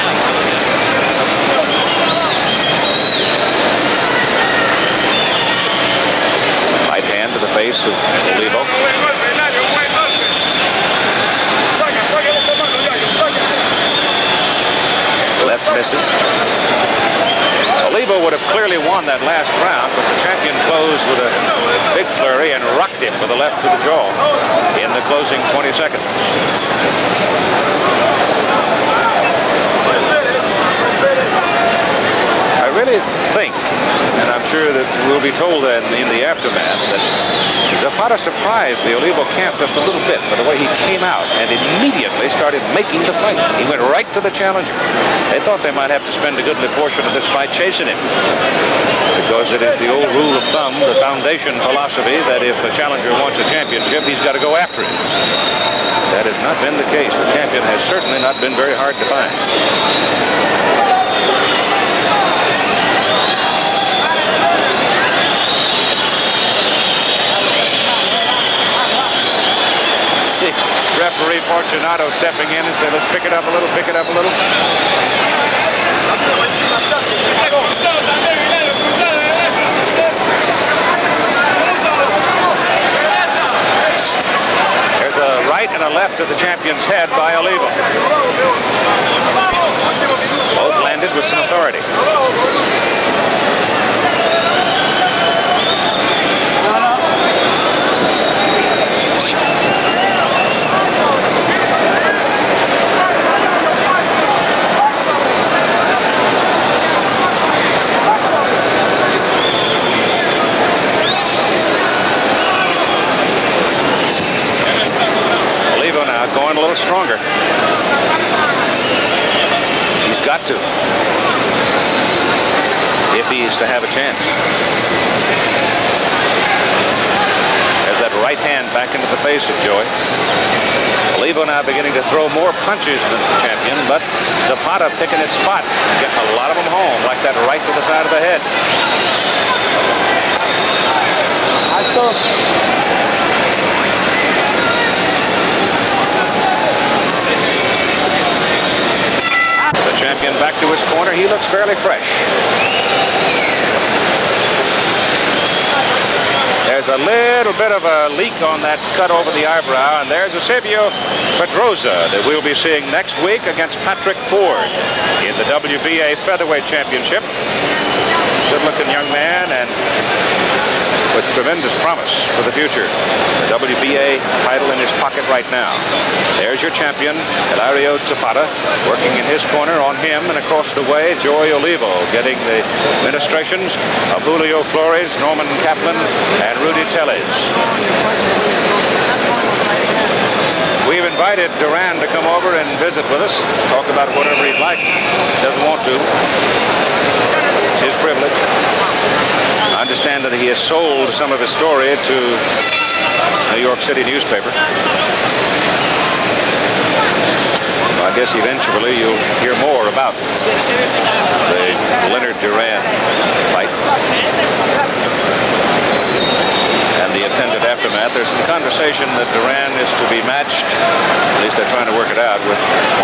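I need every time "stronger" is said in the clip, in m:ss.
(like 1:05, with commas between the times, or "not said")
1:56.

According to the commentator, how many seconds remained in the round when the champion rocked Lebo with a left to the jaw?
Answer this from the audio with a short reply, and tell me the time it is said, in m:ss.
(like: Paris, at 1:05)
20, at 0:25.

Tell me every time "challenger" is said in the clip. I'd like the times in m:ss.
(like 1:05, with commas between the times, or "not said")
0:44, 0:52.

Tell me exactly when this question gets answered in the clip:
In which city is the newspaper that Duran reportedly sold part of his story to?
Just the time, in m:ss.
3:23.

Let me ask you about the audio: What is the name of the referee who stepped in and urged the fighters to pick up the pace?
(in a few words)
Fortunato.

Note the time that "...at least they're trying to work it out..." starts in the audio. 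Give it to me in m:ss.
3:40.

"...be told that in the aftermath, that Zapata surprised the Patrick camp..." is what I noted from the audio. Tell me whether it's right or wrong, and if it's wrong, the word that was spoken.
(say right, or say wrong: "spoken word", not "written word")
wrong: "Olivo", not "Patrick".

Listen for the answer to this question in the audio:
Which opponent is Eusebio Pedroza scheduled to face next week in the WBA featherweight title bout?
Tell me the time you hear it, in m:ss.
2:43.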